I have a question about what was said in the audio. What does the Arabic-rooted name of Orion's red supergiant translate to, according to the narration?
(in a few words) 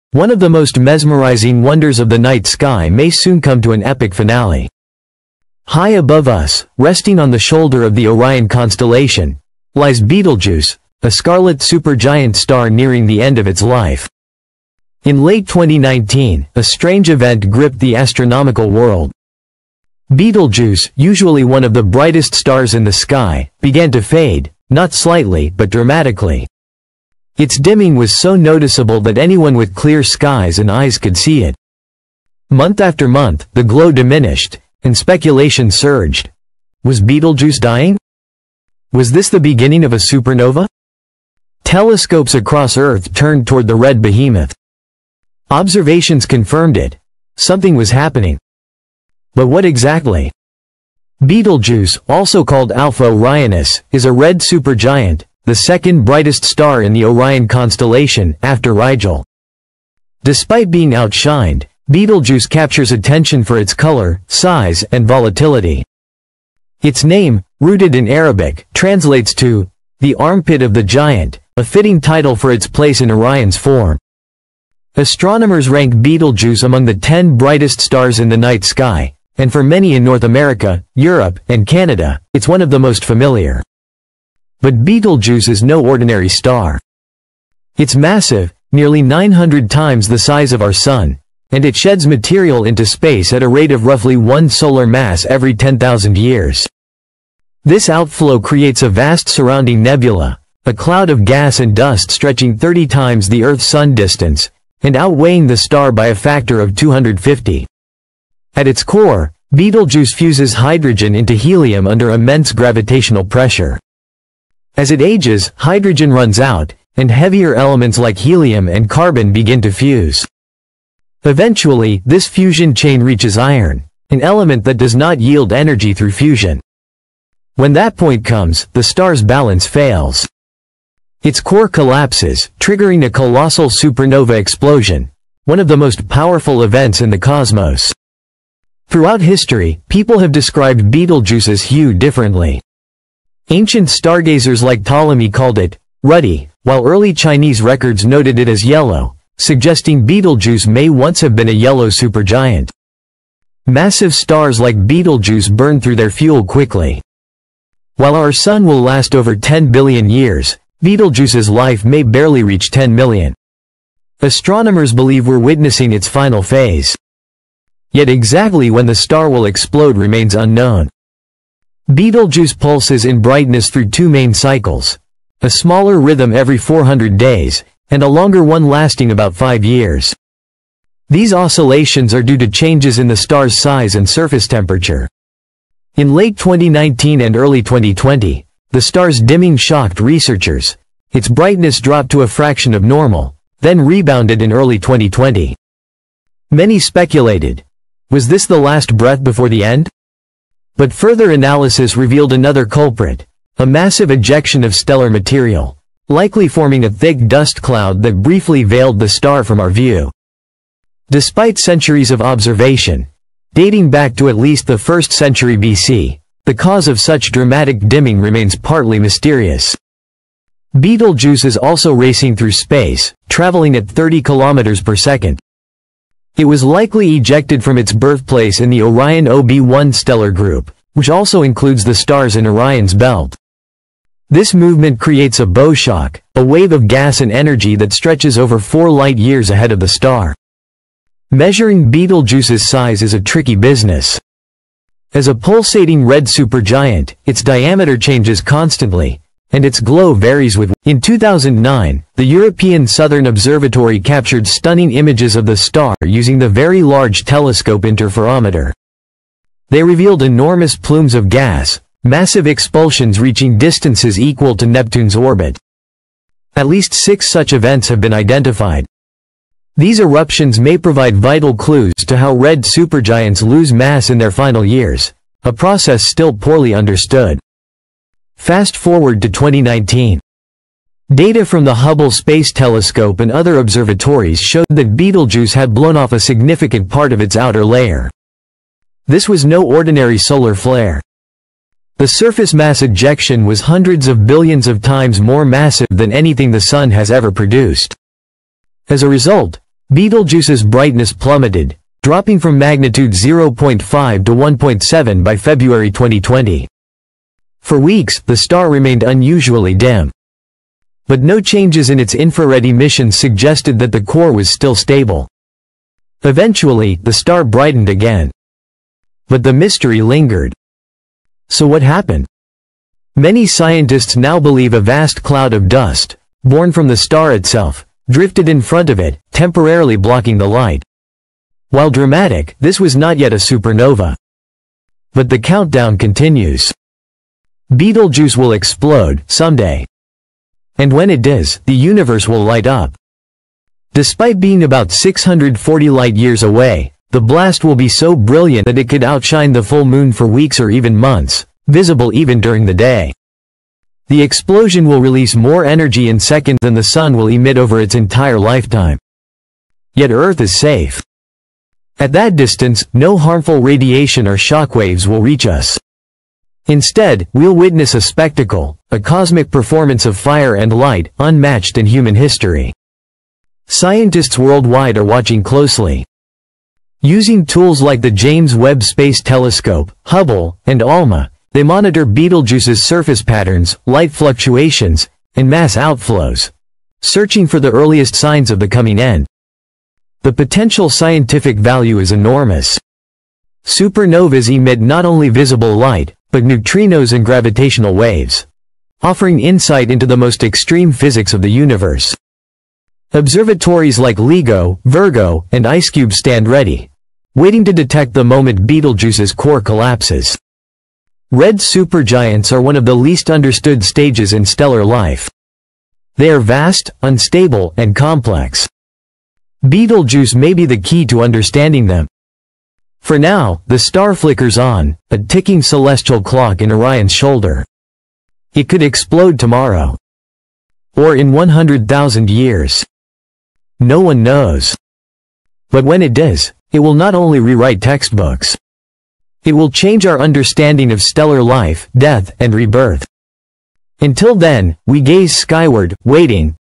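the armpit of the giant.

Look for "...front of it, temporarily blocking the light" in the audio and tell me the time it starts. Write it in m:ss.
5:28.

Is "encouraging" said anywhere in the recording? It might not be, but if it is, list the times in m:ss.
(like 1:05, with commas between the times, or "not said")
not said.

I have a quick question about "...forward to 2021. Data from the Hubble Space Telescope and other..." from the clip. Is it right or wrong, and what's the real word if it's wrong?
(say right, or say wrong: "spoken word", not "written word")
wrong: "2019", not "2021".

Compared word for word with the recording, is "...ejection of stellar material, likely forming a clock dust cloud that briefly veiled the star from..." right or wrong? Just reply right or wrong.
wrong.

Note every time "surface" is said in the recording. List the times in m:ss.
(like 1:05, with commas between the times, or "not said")
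3:04, 4:52, 6:22.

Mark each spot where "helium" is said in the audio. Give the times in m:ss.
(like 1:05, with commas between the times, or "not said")
1:51, 1:58.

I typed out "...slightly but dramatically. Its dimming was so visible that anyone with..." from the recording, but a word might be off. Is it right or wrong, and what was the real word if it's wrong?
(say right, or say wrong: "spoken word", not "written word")
wrong: "noticeable", not "visible".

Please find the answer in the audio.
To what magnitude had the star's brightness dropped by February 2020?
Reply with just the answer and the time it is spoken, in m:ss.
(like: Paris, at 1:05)
1.7, at 5:04.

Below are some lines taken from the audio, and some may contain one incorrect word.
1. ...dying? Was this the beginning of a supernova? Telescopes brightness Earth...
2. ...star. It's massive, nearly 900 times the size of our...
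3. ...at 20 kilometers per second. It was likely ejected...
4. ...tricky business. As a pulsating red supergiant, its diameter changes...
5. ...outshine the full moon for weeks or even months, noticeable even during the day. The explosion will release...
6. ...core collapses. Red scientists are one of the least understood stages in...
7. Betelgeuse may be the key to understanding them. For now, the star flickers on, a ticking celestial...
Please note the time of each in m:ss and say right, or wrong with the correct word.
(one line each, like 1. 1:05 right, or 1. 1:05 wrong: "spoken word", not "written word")
1. 0:37 wrong: "across", not "brightness"
2. 1:26 right
3. 3:43 wrong: "30", not "20"
4. 4:03 right
5. 5:49 wrong: "visible", not "noticeable"
6. 6:49 wrong: "supergiants", not "scientists"
7. 6:59 right.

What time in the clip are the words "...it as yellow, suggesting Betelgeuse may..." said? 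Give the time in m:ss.
2:28.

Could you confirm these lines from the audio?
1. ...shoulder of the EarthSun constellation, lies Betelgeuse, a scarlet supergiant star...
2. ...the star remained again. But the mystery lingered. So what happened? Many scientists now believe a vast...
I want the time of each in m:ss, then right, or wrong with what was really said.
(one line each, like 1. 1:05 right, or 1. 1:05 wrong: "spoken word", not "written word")
1. 0:07 wrong: "Orion", not "EarthSun"
2. 5:17 wrong: "brightened", not "remained".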